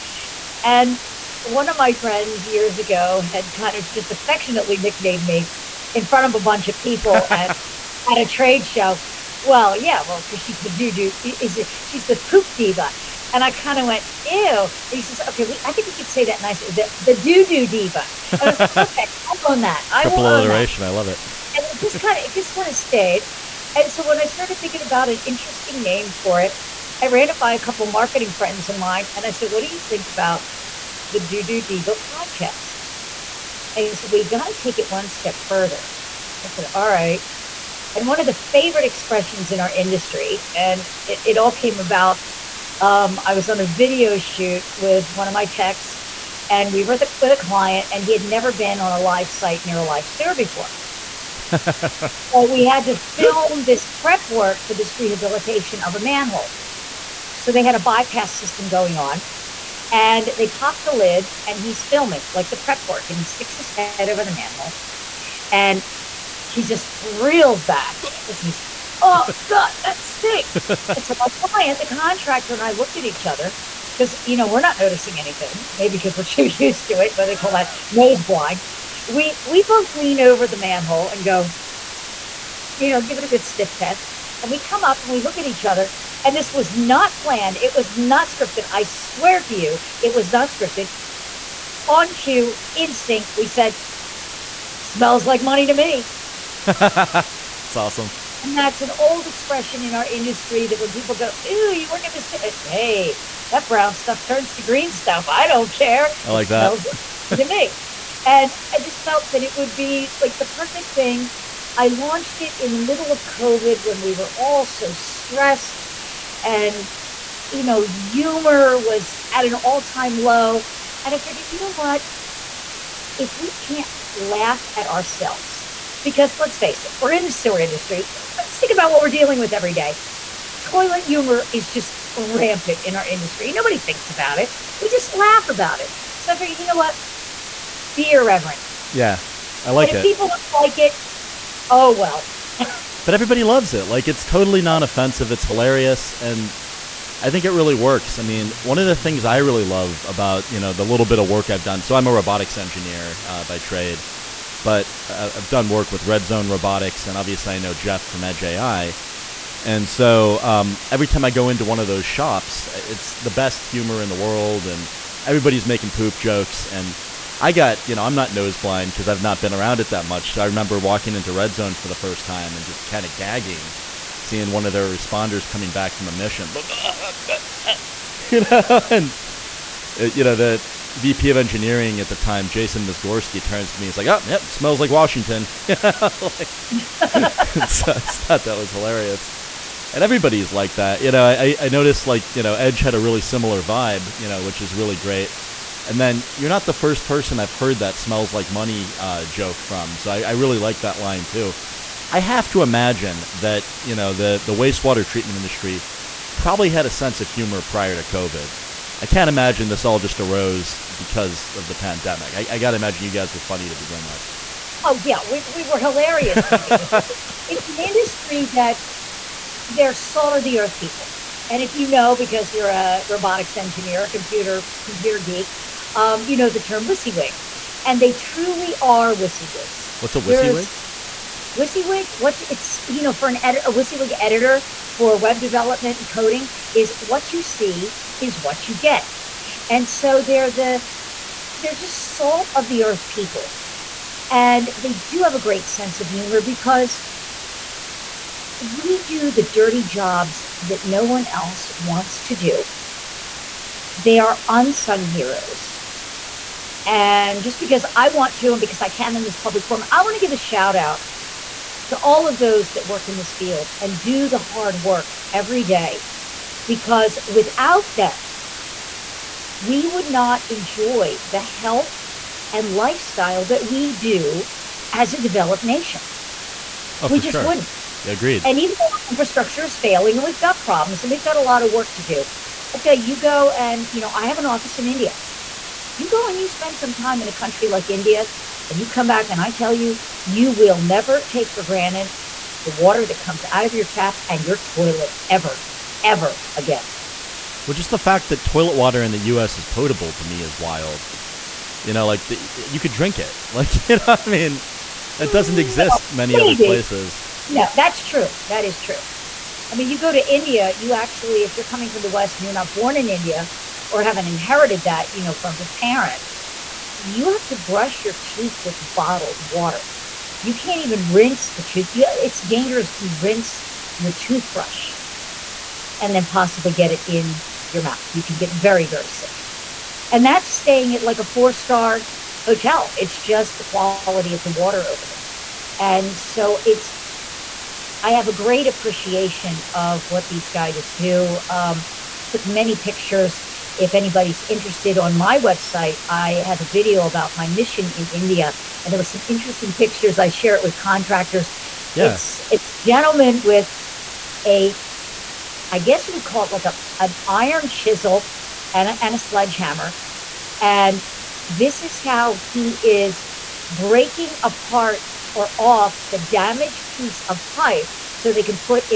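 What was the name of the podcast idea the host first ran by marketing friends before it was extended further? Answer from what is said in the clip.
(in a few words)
the Doo Doo Diva podcast.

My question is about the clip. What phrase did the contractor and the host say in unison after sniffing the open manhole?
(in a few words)
Smells like money to me.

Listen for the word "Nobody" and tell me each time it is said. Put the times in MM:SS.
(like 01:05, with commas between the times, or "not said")
02:13.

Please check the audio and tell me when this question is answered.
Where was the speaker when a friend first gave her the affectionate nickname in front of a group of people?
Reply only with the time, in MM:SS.
00:08.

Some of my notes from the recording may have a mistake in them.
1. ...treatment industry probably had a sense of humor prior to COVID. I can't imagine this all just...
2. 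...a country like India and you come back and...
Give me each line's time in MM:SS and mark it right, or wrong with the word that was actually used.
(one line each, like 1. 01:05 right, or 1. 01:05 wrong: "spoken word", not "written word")
1. 03:25 right
2. 04:47 right.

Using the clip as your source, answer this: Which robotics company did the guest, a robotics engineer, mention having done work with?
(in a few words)
Red Zone Robotics.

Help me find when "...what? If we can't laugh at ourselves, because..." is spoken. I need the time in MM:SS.
02:01.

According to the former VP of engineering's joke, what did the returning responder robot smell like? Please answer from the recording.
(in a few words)
Washington.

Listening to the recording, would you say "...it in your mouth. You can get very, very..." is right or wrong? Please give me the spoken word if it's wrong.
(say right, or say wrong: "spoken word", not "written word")
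right.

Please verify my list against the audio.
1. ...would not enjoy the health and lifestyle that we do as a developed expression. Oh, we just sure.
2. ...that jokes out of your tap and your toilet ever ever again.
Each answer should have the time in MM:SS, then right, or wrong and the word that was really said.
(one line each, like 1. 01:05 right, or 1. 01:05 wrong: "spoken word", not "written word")
1. 04:29 wrong: "nation", not "expression"
2. 04:53 wrong: "comes", not "jokes".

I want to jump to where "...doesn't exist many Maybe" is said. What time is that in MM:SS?
05:05.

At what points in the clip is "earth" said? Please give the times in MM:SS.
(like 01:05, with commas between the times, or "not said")
03:40, 04:02.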